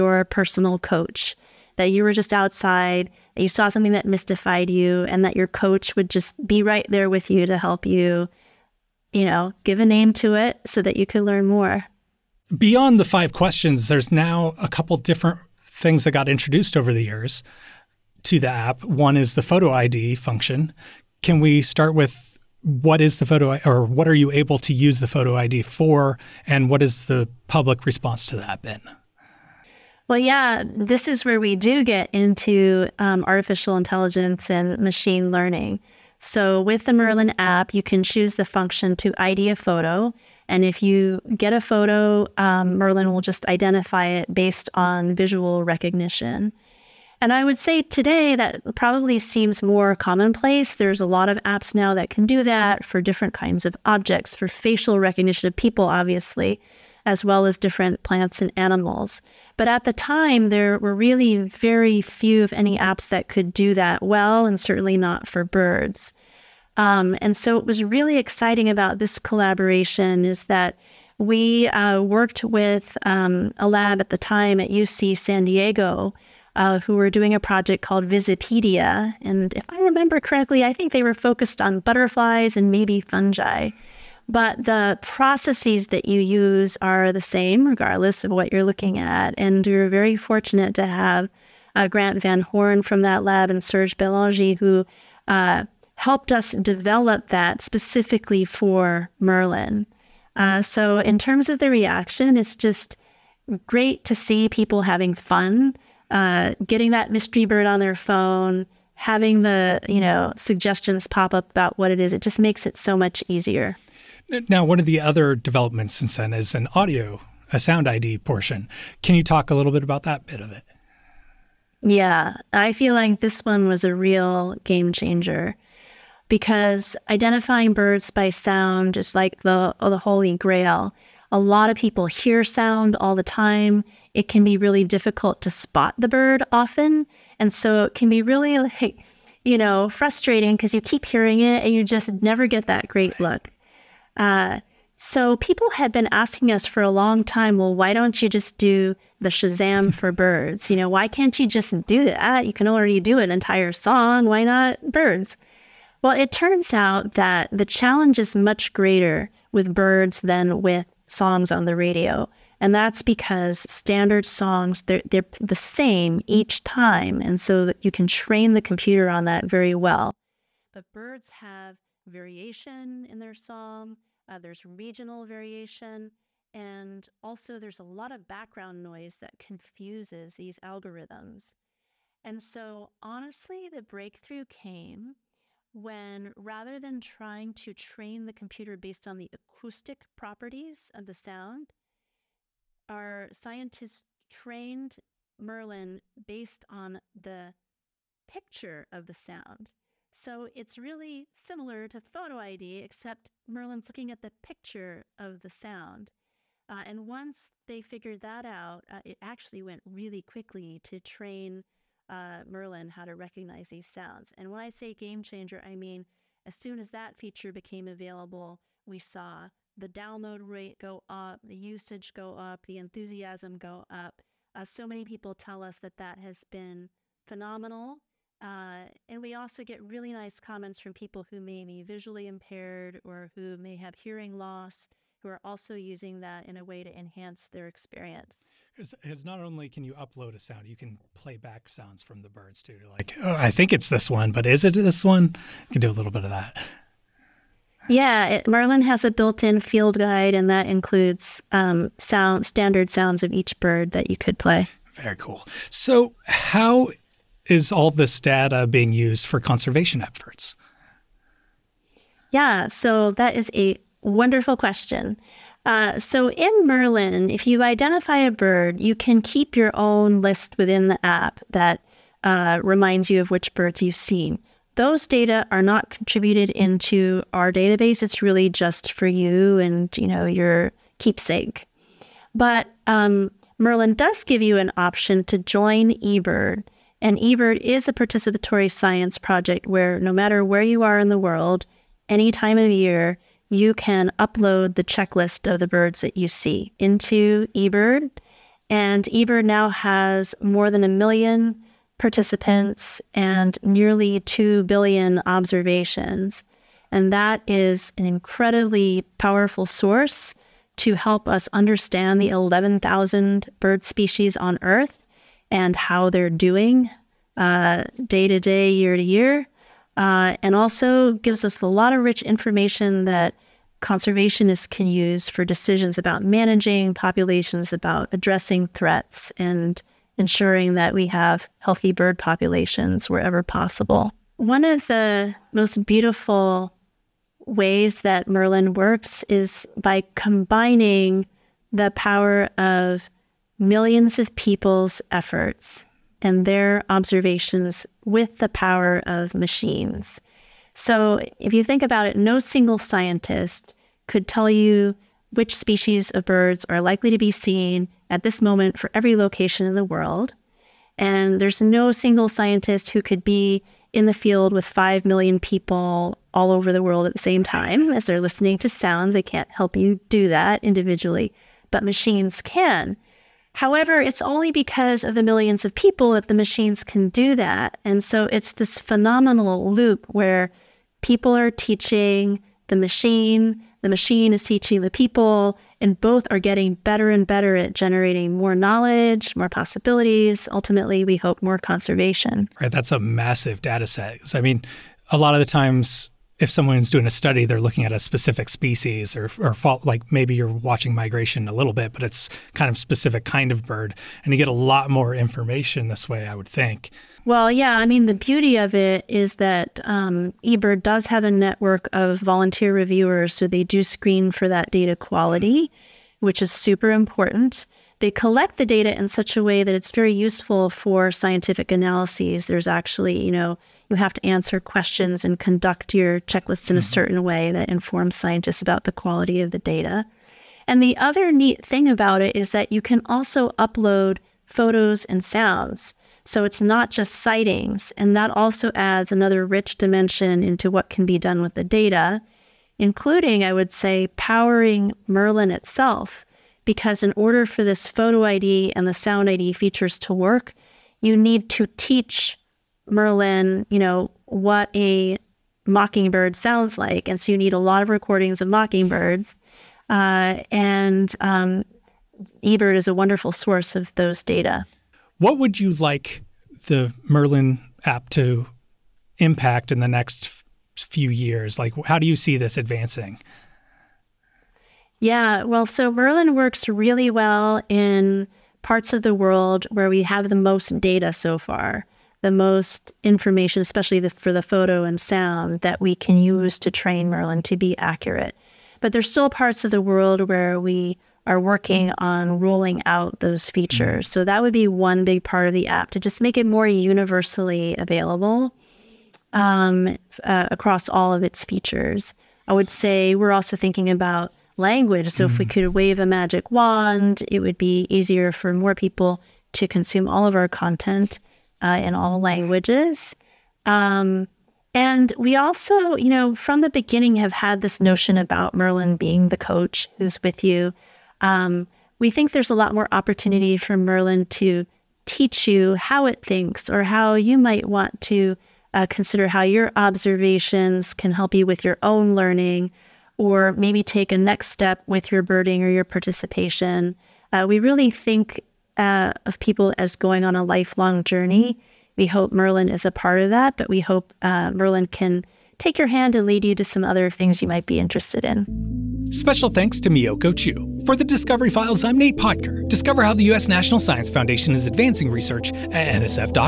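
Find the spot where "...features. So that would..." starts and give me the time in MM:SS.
08:13.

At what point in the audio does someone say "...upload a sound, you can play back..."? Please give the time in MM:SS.
03:59.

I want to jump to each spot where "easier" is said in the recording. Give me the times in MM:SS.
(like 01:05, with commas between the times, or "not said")
01:53, 08:27.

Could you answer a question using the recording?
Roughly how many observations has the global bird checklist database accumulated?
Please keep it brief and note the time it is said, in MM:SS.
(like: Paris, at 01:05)
nearly 2 billion, at 05:03.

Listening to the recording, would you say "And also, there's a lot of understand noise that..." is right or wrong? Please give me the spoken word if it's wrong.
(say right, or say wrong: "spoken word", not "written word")
wrong: "background", not "understand".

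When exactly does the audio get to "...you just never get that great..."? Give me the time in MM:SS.
02:21.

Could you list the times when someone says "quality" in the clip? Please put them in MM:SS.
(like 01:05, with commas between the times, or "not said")
06:54, 07:08.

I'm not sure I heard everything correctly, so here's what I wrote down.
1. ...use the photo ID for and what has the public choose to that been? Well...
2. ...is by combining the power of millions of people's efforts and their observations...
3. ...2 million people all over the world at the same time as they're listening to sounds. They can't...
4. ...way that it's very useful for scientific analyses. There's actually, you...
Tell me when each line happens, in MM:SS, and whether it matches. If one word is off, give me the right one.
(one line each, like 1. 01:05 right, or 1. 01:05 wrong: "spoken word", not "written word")
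1. 00:24 wrong: "response", not "choose"
2. 05:39 right
3. 06:04 wrong: "5", not "2"
4. 06:59 right.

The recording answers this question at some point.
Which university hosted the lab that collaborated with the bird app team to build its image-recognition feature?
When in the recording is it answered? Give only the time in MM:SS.
01:14.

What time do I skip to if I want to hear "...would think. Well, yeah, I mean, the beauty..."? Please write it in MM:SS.
06:46.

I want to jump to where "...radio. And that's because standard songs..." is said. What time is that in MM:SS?
02:41.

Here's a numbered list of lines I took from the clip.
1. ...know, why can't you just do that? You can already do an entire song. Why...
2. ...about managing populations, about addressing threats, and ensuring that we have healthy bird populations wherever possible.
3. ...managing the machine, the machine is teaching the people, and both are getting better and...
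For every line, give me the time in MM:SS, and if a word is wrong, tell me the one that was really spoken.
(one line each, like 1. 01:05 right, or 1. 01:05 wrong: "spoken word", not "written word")
1. 02:30 right
2. 05:25 right
3. 06:21 wrong: "teaching", not "managing".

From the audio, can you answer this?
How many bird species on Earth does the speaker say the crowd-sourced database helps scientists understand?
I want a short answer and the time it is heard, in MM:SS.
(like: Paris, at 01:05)
11,000, at 05:12.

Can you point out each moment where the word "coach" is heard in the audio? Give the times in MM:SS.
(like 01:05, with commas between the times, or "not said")
00:00, 00:05, 08:39.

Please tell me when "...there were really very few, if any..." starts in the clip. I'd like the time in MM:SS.
01:00.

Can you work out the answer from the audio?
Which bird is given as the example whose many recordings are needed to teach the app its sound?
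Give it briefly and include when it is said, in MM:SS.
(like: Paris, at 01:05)
mockingbird, at 07:35.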